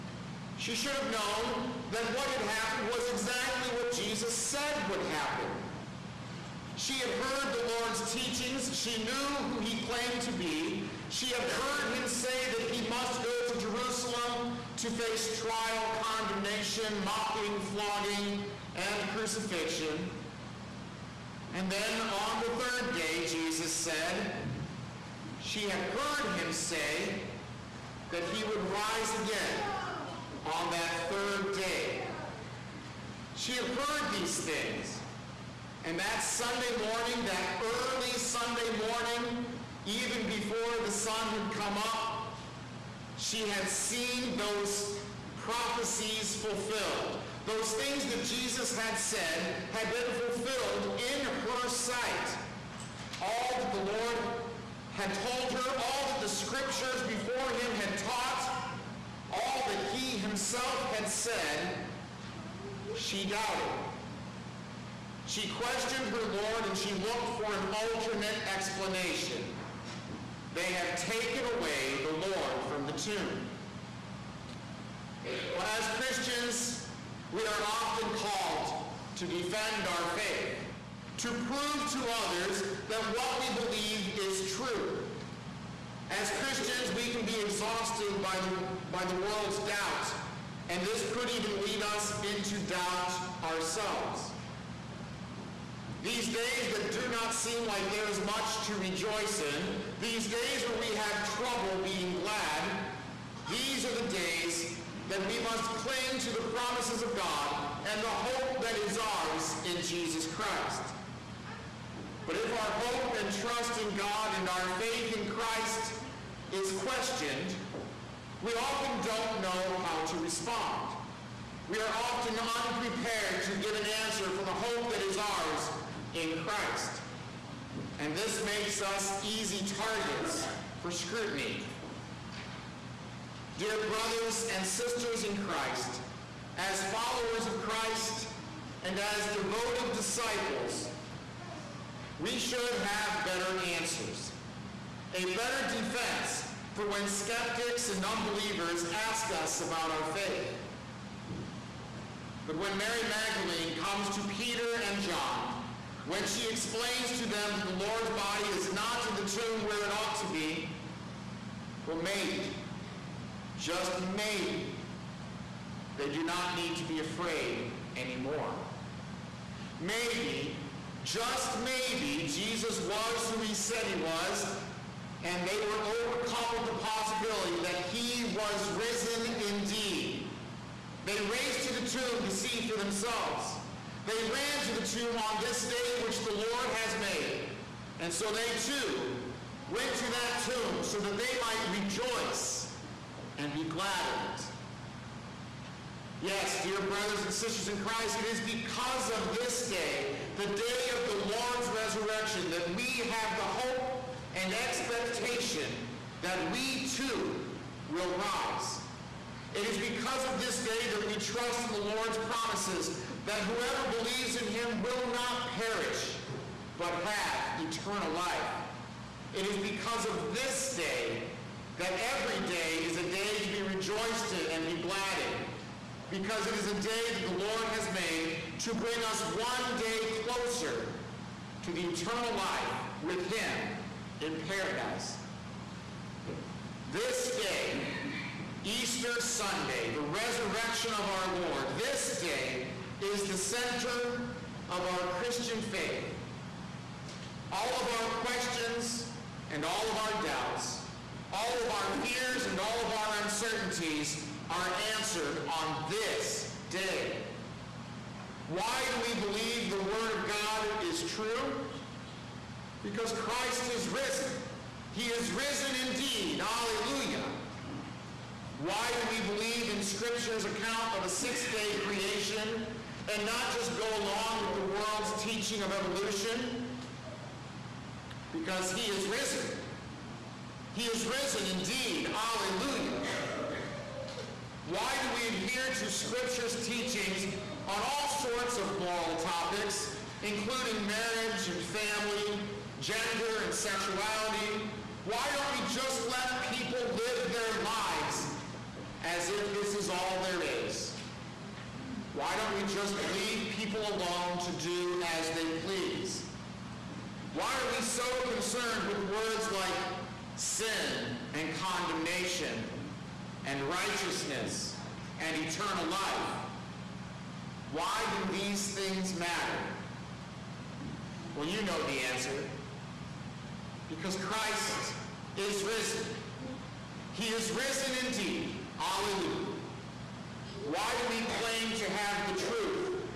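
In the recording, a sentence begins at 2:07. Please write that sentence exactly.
And this makes us easy targets for scrutiny.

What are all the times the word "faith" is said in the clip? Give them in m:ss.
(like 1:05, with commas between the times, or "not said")
1:20, 1:54, 2:30, 4:05.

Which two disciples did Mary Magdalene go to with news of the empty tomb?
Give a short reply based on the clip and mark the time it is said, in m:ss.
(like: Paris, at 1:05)
Peter and John, at 2:34.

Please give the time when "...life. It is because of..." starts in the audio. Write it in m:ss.
3:38.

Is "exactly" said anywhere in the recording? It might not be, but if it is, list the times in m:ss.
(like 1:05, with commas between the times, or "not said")
0:03.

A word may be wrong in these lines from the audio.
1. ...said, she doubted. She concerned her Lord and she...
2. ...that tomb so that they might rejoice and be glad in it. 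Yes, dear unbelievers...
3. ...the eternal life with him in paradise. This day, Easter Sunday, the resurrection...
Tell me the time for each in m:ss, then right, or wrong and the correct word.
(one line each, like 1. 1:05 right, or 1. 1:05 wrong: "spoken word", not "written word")
1. 1:01 wrong: "questioned", not "concerned"
2. 3:10 wrong: "brothers", not "unbelievers"
3. 3:51 right.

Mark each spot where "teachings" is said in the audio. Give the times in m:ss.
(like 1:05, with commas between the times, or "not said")
0:08, 4:35, 4:46.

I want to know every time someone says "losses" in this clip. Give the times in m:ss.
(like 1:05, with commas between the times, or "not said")
not said.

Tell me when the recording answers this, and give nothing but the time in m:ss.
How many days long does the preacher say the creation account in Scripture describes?
4:31.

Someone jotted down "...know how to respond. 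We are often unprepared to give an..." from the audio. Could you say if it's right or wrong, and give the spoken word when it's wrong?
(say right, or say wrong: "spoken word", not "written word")
right.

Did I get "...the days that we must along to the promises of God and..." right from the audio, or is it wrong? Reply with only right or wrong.
wrong.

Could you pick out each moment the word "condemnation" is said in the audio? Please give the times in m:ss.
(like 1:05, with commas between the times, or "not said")
0:16, 5:11.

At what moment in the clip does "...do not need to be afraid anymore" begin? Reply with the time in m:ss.
2:46.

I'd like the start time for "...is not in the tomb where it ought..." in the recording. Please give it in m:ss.
2:38.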